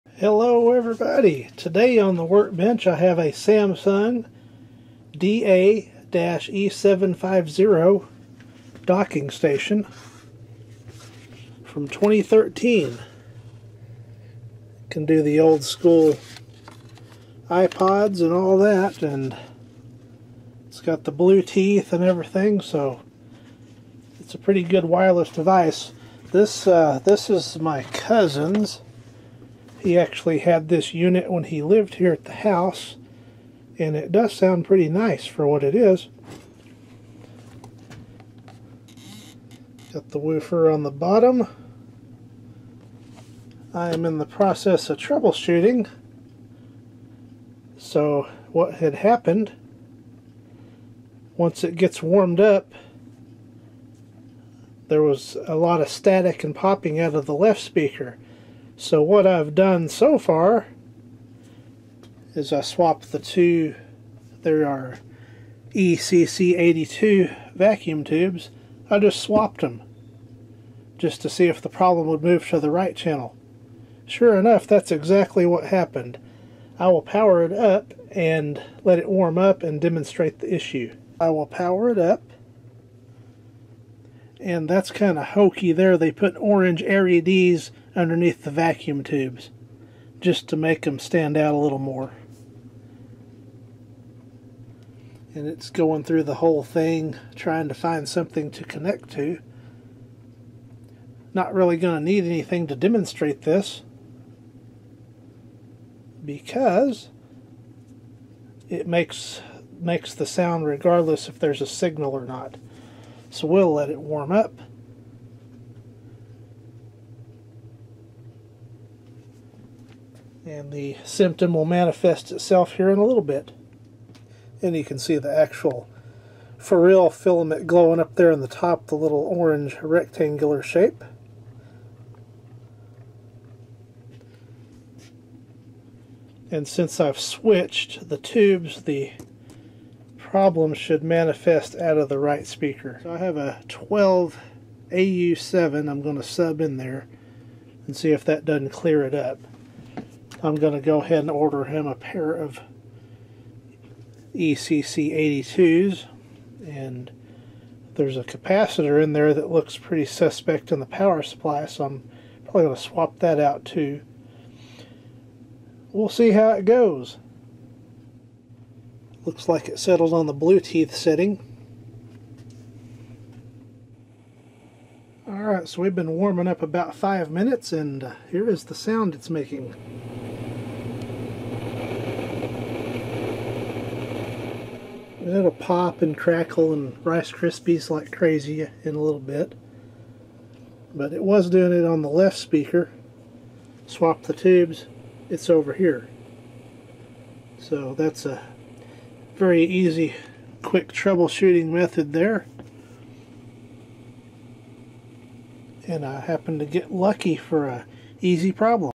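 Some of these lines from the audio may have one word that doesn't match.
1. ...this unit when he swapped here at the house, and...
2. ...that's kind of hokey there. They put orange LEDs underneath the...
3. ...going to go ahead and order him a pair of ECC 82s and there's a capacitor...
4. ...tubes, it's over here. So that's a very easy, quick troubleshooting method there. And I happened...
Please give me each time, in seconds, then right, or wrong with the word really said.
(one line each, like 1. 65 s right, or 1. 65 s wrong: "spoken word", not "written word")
1. 30 s wrong: "lived", not "swapped"
2. 84 s right
3. 150 s right
4. 194 s right.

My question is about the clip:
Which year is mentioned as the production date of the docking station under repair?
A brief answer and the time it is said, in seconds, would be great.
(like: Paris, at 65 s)
2013, at 11 s.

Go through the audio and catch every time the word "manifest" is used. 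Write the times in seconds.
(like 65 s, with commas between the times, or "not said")
121 s, 141 s.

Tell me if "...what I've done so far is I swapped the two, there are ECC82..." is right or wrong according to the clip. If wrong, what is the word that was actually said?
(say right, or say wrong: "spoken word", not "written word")
right.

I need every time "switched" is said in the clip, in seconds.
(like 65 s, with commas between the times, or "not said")
137 s.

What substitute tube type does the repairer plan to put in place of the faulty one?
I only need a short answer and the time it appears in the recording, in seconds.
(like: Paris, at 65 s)
12AU7, at 143 s.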